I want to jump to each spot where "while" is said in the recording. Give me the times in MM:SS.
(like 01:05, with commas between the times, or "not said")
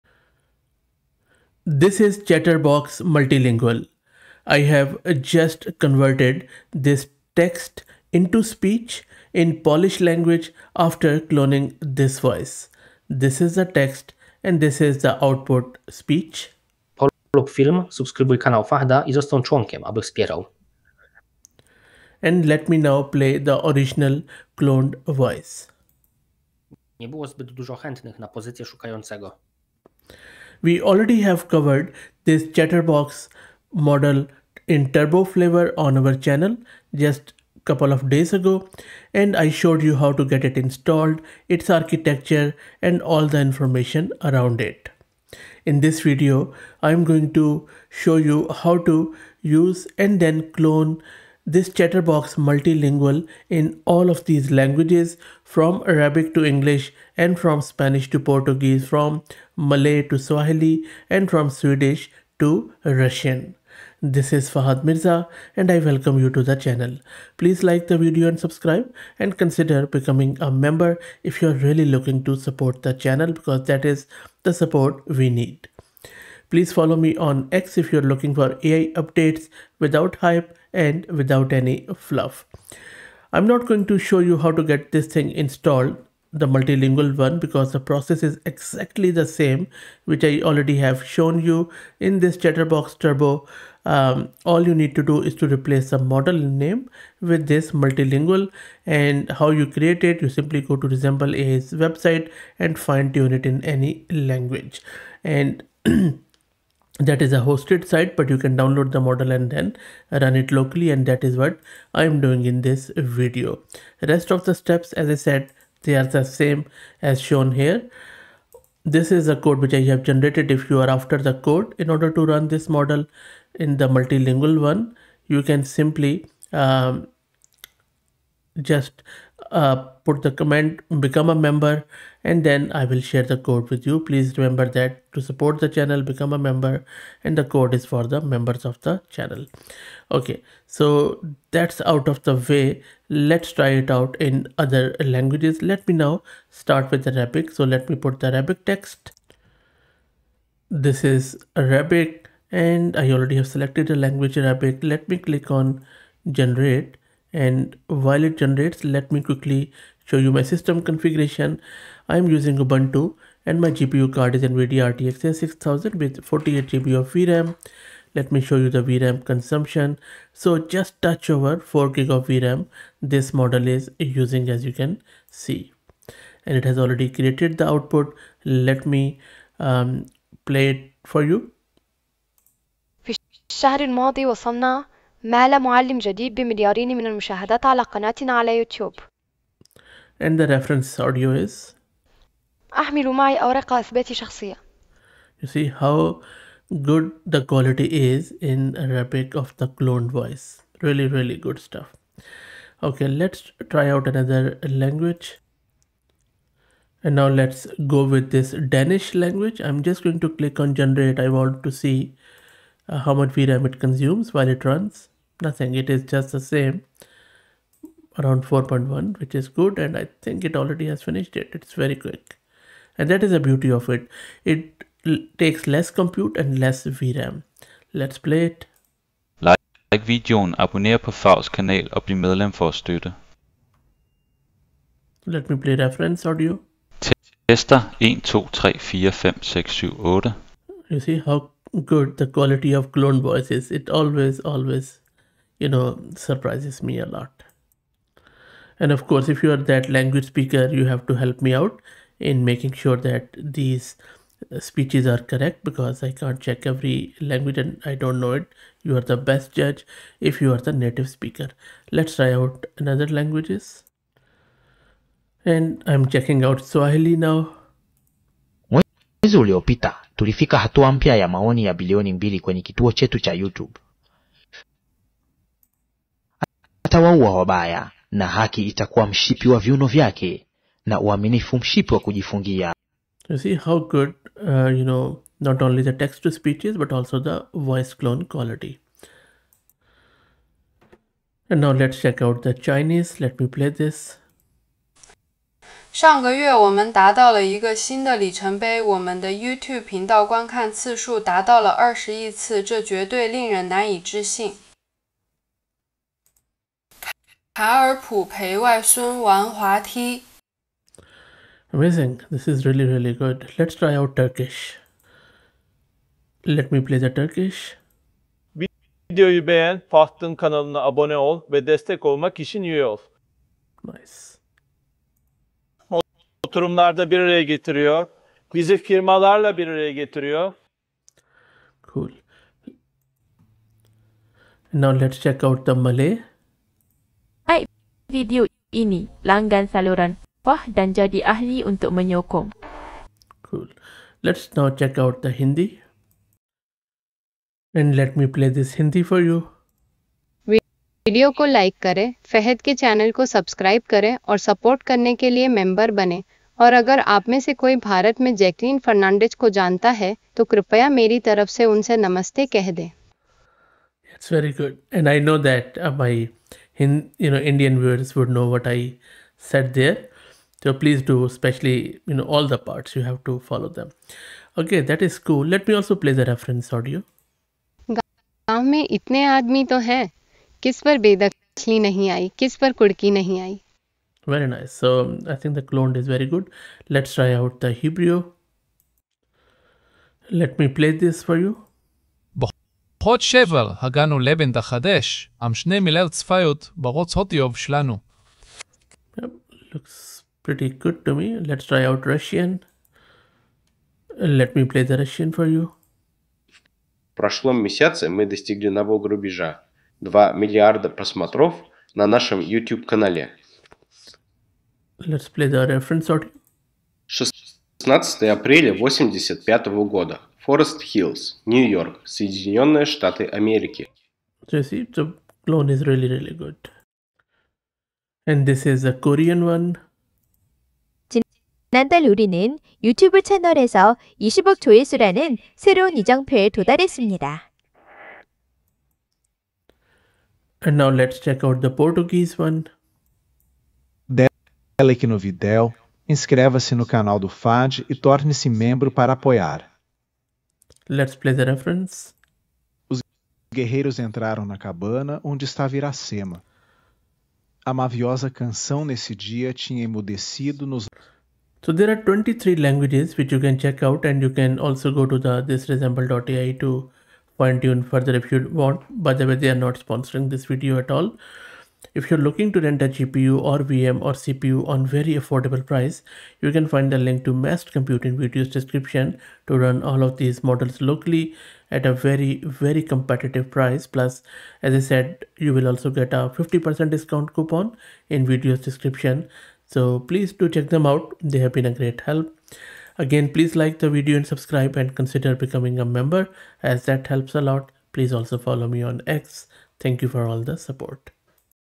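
02:37, 03:34.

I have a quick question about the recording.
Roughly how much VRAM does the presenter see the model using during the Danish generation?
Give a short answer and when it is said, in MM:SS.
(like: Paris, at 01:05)
4.1, at 03:38.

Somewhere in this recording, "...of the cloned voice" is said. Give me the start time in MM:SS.
03:19.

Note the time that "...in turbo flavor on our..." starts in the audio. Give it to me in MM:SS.
00:34.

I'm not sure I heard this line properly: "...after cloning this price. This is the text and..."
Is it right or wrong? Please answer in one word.
wrong.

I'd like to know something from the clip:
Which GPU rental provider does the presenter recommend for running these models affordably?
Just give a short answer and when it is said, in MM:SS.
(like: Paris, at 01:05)
Massed Compute, at 07:57.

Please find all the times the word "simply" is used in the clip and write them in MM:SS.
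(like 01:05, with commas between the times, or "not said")
01:40, 02:05.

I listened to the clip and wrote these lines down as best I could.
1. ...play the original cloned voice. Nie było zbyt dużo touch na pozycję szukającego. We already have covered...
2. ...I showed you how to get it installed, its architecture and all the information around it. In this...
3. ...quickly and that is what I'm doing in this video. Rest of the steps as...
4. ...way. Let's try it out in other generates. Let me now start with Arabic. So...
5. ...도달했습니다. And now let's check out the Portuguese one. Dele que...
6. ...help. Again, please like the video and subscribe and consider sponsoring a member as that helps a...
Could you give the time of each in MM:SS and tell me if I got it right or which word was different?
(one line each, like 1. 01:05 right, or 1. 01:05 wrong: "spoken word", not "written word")
1. 00:23 wrong: "chętnych", not "touch"
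2. 00:39 right
3. 01:50 wrong: "locally", not "quickly"
4. 02:22 wrong: "languages", not "generates"
5. 07:16 right
6. 08:12 wrong: "becoming", not "sponsoring".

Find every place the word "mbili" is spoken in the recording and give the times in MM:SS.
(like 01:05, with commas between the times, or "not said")
04:32.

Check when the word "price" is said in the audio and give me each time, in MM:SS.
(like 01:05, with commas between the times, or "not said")
07:55, 08:03.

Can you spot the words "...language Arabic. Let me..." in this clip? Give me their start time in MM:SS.
02:33.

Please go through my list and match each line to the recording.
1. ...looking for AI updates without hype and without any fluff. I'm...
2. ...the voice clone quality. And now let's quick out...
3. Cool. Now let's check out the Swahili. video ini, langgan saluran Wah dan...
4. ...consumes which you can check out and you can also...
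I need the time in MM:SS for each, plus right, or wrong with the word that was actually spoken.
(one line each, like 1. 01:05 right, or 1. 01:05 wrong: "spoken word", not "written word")
1. 01:18 right
2. 04:47 wrong: "check", not "quick"
3. 05:31 wrong: "Malay", not "Swahili"
4. 07:42 wrong: "languages", not "consumes".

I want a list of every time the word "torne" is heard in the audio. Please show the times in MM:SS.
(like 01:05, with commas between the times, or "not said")
07:27.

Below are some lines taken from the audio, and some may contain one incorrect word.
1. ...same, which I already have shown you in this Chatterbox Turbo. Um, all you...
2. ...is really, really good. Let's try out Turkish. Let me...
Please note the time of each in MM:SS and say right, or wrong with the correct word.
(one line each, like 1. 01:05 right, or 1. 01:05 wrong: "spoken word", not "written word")
1. 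01:29 right
2. 05:12 right.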